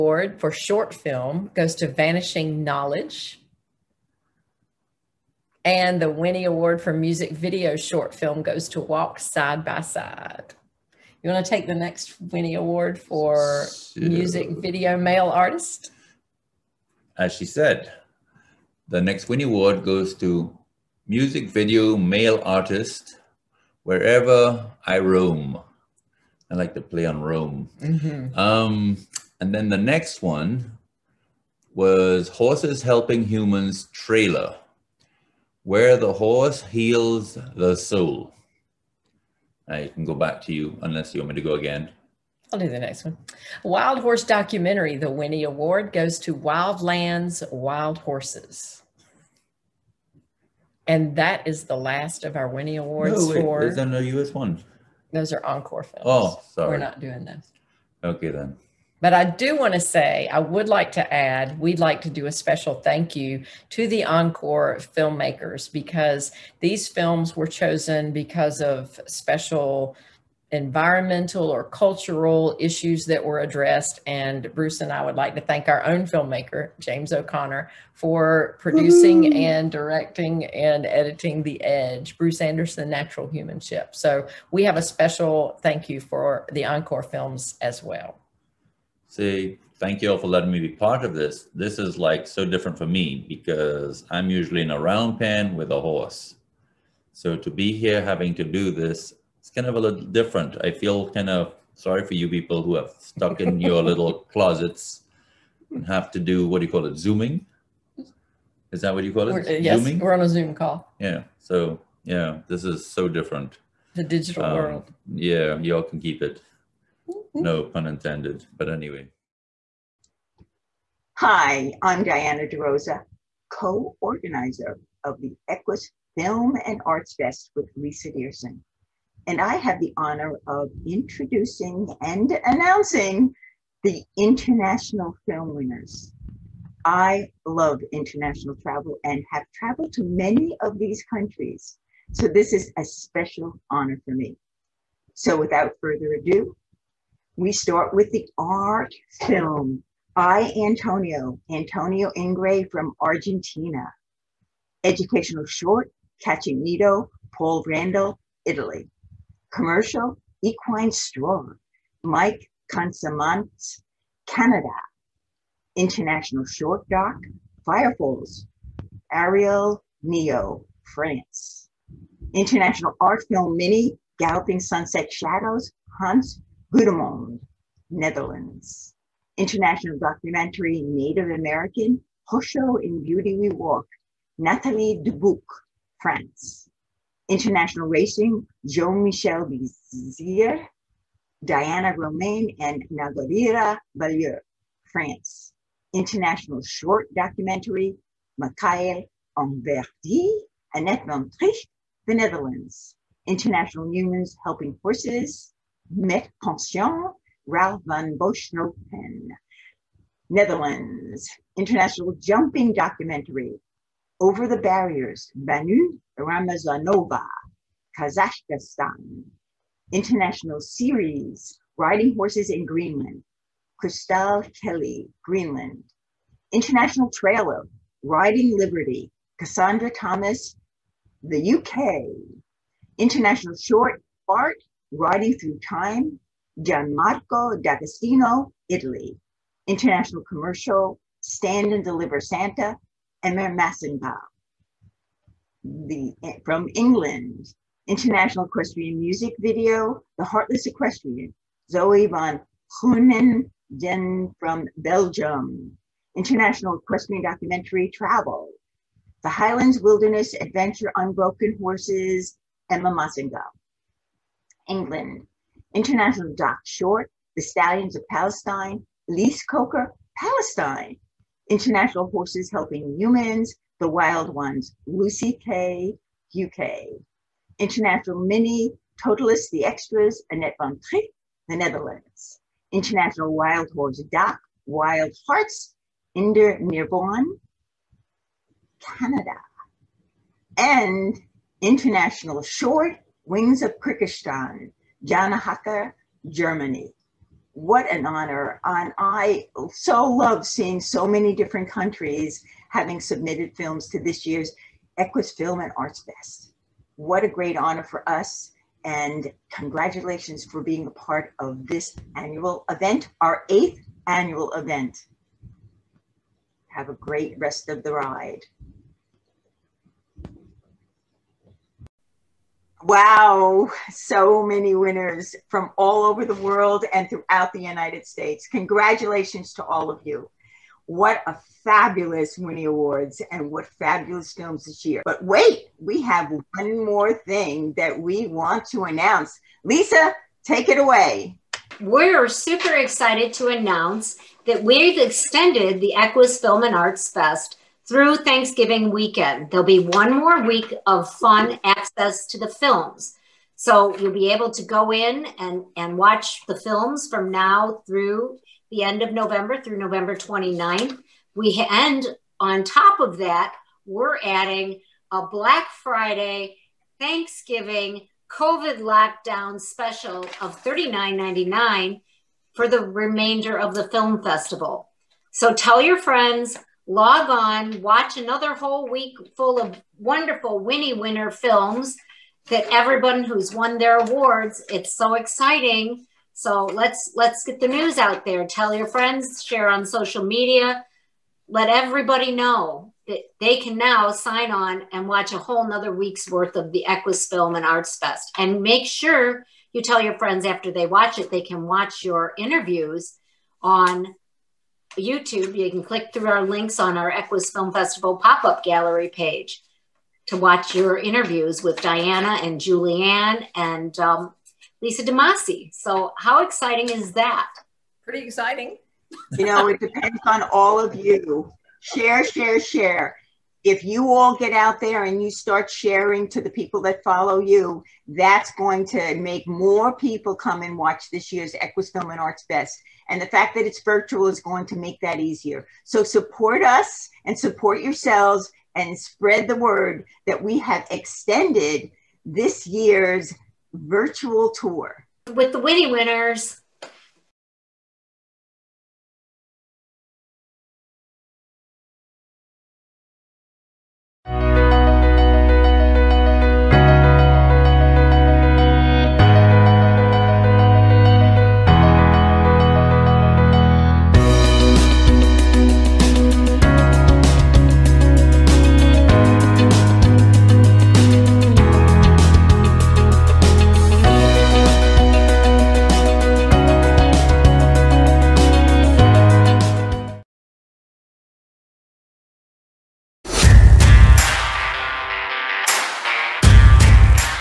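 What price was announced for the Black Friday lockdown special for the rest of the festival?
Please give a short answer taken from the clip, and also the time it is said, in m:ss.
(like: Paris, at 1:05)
$39.99, at 6:10.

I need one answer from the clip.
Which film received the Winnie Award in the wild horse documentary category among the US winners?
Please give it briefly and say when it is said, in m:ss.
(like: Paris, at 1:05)
Wildlands Wild Horses, at 0:46.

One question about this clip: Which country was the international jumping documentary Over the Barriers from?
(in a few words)
Kazakhstan.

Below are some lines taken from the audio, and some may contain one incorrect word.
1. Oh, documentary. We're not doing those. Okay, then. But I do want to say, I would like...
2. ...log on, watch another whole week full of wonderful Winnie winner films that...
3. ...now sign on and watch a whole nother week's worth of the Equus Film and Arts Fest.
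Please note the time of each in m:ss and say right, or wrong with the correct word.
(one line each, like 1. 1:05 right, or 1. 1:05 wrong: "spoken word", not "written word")
1. 0:56 wrong: "sorry", not "documentary"
2. 6:16 right
3. 6:33 right.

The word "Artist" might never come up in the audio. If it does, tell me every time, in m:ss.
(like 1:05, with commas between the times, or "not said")
0:15, 0:22.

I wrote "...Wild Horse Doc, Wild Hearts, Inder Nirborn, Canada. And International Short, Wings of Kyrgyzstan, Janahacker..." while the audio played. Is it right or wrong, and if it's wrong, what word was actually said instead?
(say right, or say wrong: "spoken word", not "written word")
right.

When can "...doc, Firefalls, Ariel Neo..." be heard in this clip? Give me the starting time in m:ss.
2:46.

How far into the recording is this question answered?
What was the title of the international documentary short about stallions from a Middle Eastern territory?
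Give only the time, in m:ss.
4:27.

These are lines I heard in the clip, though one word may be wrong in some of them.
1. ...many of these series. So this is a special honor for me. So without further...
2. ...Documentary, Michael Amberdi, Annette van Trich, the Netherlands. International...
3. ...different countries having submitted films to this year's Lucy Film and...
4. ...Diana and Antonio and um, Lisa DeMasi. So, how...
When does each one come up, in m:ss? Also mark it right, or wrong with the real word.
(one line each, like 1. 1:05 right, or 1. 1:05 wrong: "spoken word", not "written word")
1. 2:20 wrong: "countries", not "series"
2. 3:17 right
3. 5:01 wrong: "Equus", not "Lucy"
4. 6:51 wrong: "Julianne", not "Antonio".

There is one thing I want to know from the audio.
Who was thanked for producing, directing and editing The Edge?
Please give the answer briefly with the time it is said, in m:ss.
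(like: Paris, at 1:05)
James O'Connor, at 1:16.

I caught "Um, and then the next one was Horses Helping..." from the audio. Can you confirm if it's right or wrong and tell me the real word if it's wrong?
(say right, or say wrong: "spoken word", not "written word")
right.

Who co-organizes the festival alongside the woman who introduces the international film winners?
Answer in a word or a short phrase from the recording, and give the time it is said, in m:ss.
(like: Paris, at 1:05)
Lisa Diersen, at 2:07.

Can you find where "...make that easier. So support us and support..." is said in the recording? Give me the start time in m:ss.
7:14.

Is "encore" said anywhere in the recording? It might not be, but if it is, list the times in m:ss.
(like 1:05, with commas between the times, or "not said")
0:55, 1:04, 1:26.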